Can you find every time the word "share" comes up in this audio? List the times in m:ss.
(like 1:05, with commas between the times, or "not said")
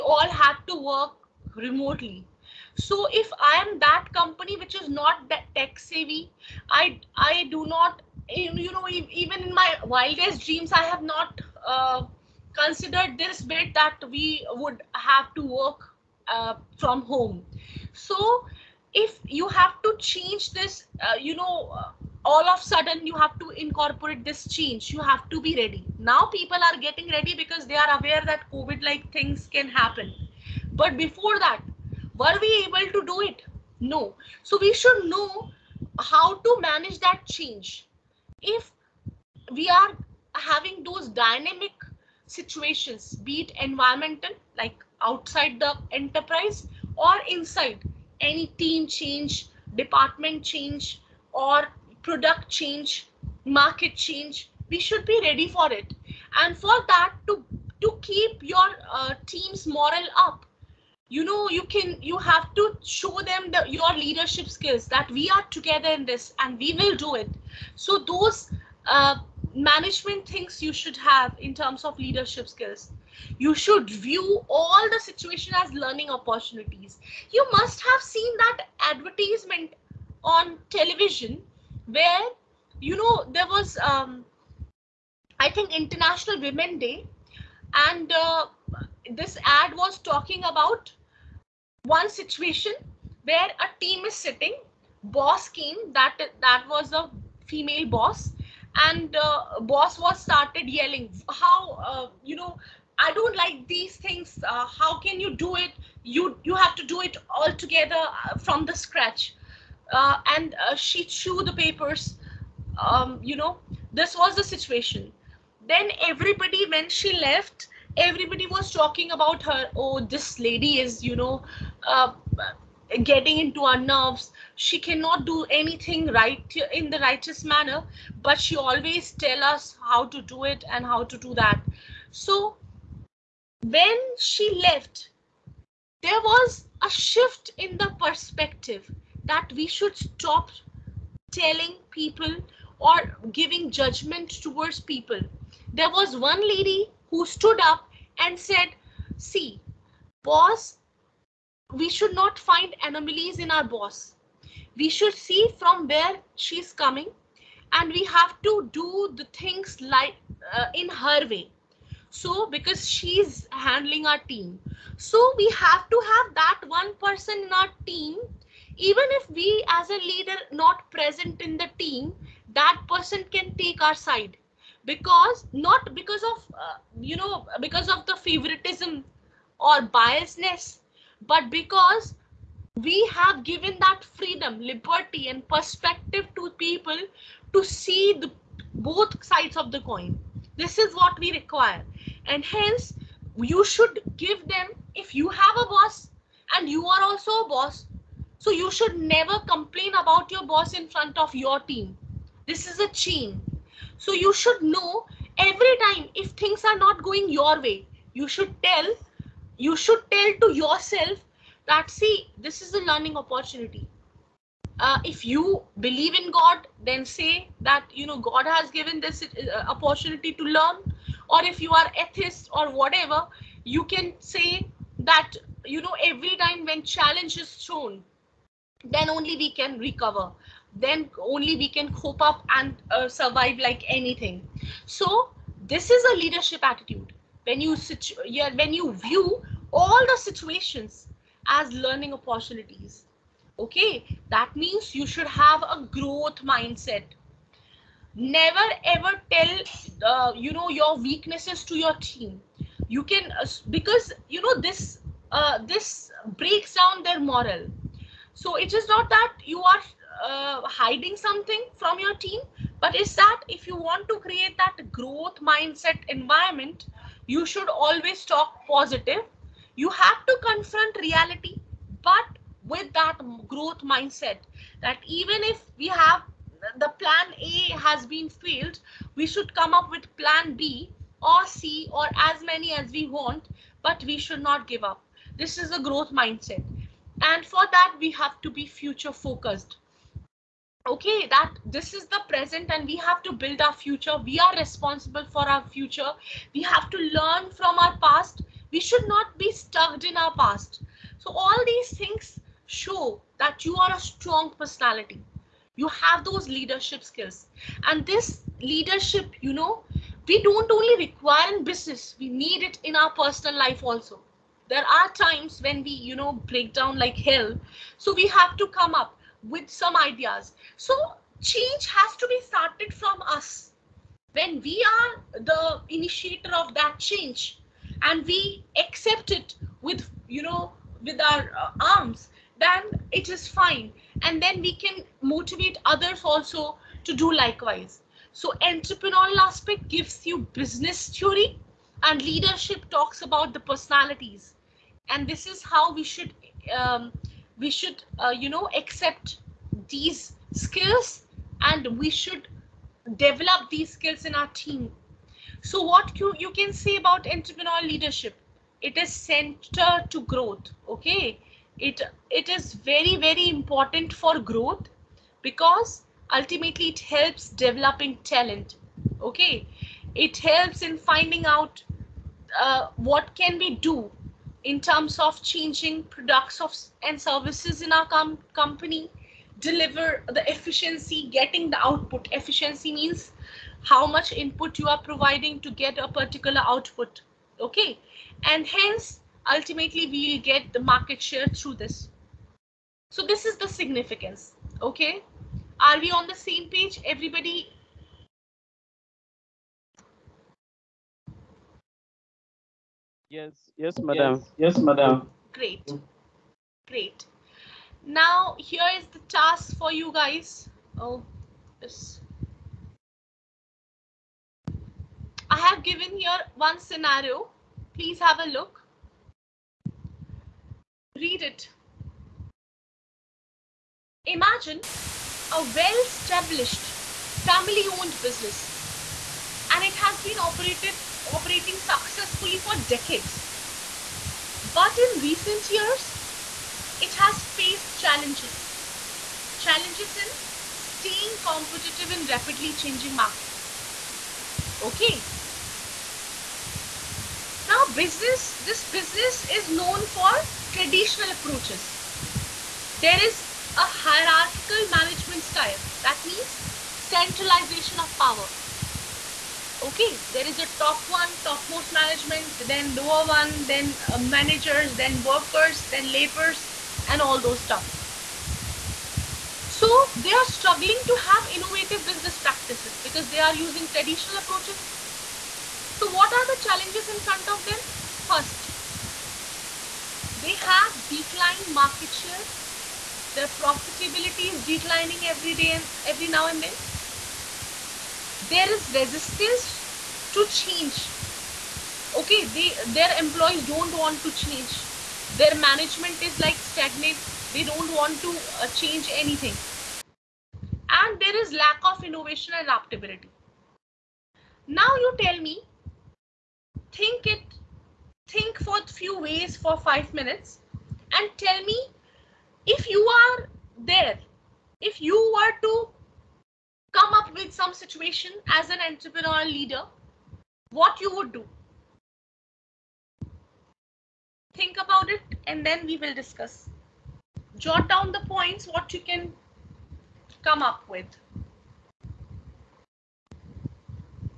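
6:31, 8:02.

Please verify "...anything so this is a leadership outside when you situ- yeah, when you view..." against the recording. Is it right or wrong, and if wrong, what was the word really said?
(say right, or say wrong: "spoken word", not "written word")
wrong: "attitude", not "outside".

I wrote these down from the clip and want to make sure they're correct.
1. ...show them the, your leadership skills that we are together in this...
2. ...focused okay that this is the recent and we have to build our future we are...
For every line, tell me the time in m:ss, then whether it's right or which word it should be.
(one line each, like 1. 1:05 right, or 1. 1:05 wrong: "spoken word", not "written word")
1. 1:02 right
2. 4:49 wrong: "present", not "recent".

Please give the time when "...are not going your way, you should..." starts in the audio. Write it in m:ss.
3:26.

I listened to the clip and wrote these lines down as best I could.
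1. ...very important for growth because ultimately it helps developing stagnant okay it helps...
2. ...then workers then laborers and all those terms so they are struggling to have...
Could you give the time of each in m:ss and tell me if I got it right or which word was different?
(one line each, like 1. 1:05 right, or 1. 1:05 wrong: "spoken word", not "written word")
1. 6:03 wrong: "talent", not "stagnant"
2. 7:45 right.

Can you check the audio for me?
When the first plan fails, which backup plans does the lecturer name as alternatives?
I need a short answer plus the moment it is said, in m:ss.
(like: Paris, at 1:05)
Plan B or C, at 4:40.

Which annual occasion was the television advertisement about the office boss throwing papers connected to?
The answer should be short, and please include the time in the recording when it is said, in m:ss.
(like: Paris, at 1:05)
International Women's Day, at 1:25.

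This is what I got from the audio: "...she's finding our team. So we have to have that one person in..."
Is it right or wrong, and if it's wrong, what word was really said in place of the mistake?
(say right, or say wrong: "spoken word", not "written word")
wrong: "handling", not "finding".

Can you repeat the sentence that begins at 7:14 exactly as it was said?
But in recent years, it has faced challenges.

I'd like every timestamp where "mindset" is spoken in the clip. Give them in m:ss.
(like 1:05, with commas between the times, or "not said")
4:06, 4:25, 4:33, 4:46.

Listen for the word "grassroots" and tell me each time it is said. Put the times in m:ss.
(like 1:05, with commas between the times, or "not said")
not said.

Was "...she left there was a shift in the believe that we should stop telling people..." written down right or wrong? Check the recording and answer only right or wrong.
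wrong.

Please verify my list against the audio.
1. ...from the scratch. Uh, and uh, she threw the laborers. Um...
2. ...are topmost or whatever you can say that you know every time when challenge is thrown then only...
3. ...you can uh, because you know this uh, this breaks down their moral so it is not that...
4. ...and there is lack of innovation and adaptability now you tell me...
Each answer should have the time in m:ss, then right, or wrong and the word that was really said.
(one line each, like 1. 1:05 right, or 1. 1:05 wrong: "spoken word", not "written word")
1. 1:48 wrong: "papers", not "laborers"
2. 3:41 wrong: "atheist", not "topmost"
3. 4:12 right
4. 8:20 right.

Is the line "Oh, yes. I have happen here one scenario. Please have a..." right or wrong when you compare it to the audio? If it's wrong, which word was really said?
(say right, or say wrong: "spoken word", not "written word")
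wrong: "given", not "happen".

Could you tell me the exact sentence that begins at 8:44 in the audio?
Think about it and then we will discuss.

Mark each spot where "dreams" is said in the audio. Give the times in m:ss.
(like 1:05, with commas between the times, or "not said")
0:10.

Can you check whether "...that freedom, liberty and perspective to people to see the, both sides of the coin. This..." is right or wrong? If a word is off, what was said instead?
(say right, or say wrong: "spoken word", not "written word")
right.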